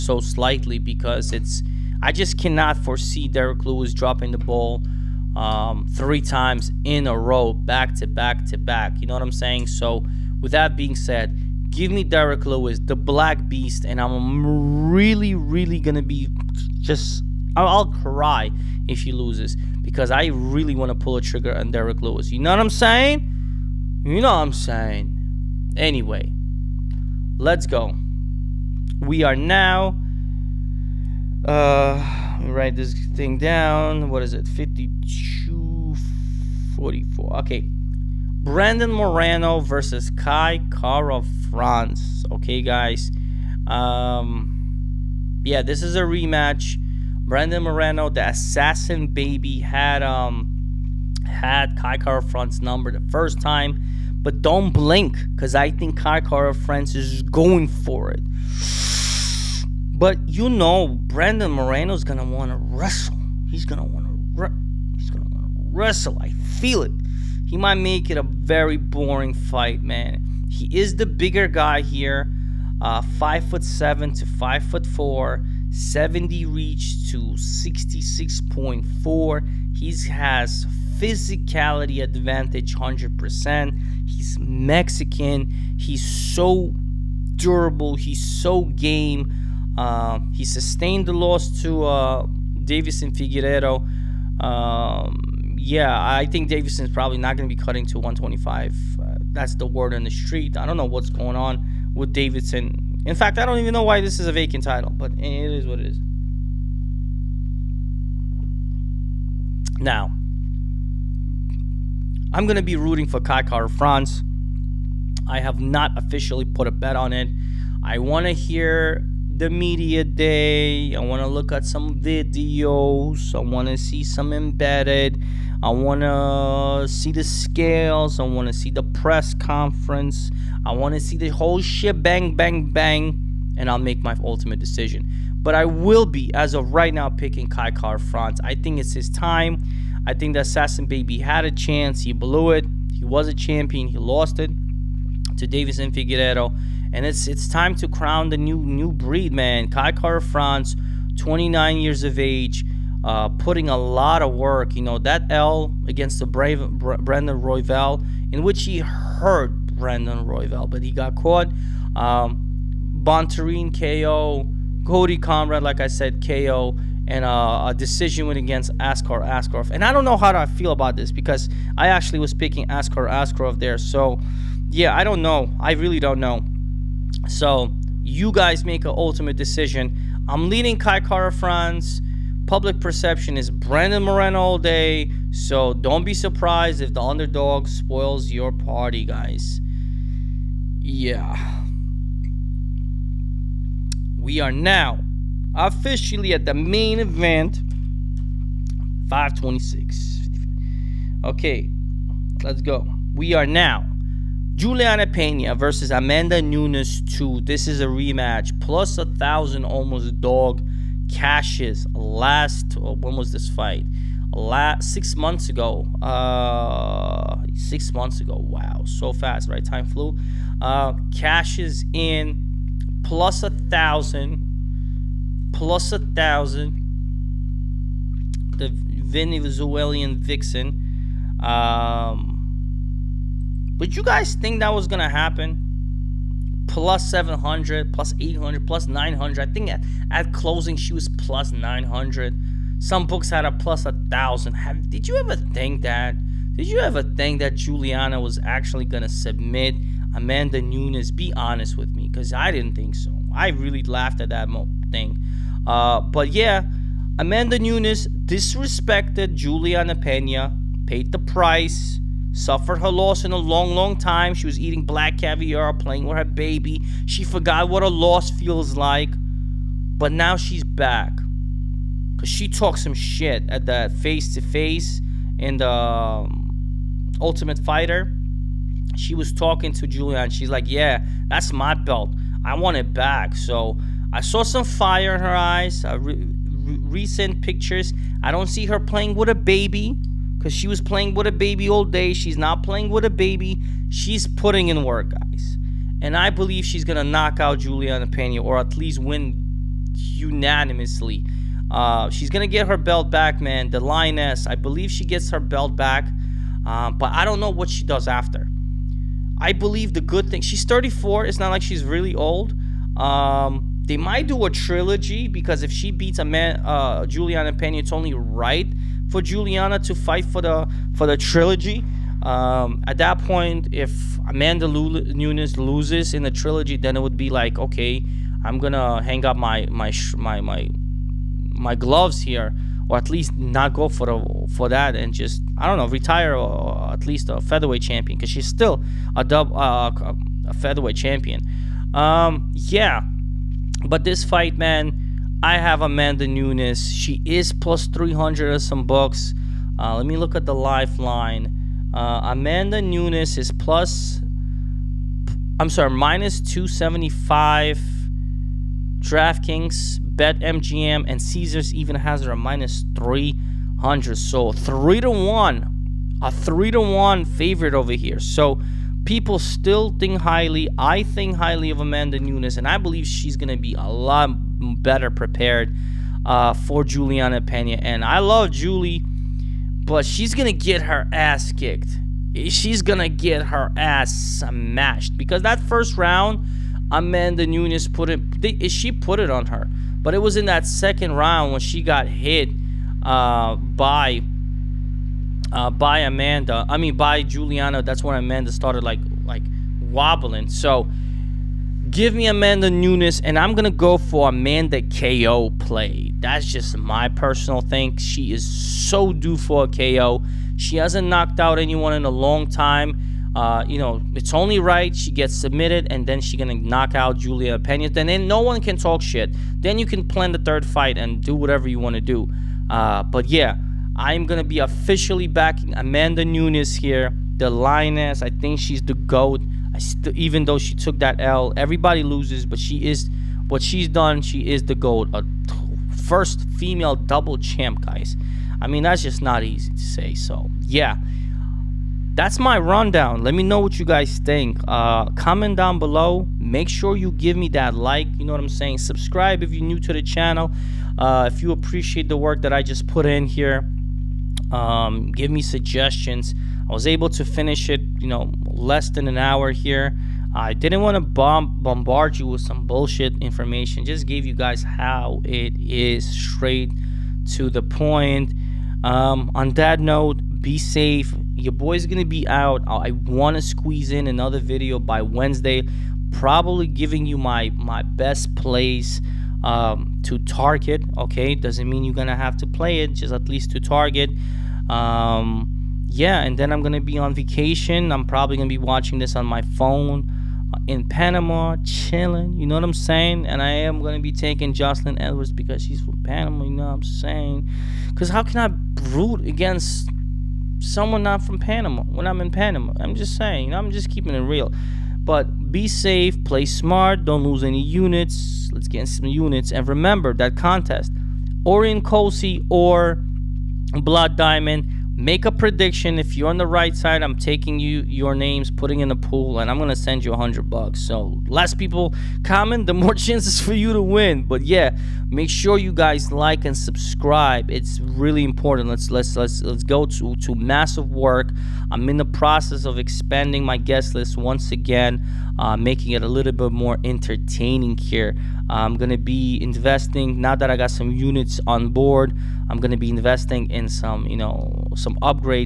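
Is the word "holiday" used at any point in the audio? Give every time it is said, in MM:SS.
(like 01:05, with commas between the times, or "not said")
not said.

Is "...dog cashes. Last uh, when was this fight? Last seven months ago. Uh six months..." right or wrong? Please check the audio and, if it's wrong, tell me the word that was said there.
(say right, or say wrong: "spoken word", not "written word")
wrong: "six", not "seven".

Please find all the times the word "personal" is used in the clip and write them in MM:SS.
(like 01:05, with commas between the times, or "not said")
06:47.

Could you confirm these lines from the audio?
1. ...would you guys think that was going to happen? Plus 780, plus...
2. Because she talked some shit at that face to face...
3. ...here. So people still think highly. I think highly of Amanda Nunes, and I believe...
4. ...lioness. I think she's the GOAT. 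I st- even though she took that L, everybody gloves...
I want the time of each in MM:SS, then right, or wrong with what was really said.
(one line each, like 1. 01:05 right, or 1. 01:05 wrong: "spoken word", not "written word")
1. 03:53 wrong: "700", not "780"
2. 04:32 right
3. 06:07 right
4. 07:07 wrong: "loses", not "gloves".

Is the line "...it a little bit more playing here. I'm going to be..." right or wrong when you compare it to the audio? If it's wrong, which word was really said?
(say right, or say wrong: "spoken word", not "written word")
wrong: "entertaining", not "playing".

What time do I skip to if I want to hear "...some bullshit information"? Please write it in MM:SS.
07:42.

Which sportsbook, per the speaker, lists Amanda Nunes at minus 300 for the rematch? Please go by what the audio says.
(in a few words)
Caesars.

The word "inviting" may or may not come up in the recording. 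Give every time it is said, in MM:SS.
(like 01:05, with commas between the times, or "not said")
not said.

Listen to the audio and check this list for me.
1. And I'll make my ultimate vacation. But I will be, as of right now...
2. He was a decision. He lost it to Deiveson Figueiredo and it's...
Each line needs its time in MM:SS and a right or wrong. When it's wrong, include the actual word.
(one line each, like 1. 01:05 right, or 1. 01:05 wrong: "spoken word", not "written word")
1. 02:13 wrong: "decision", not "vacation"
2. 02:22 wrong: "champion", not "decision".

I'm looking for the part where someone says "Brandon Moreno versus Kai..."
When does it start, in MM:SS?
00:38.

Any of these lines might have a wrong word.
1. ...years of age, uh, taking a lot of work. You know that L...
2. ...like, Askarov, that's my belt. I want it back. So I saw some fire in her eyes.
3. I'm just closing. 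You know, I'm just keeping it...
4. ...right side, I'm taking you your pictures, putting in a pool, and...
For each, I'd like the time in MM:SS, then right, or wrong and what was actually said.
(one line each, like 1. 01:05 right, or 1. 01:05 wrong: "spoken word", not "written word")
1. 02:31 wrong: "putting", not "taking"
2. 04:40 wrong: "Yeah", not "Askarov"
3. 08:22 wrong: "saying", not "closing"
4. 08:36 wrong: "names", not "pictures".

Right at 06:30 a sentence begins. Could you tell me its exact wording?
But it was in that second round when she got hit uh, by uh, by Amanda.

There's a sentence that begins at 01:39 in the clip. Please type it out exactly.
Uh, that's the word on the street.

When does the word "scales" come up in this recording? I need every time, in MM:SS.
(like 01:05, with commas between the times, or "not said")
02:07.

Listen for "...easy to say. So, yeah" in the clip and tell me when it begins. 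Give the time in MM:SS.
07:19.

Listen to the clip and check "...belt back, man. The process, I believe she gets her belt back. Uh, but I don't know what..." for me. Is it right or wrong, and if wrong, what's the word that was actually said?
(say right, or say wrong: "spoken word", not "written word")
wrong: "lioness", not "process".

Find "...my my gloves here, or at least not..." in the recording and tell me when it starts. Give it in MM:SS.
05:30.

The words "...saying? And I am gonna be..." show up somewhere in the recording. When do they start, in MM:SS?
08:12.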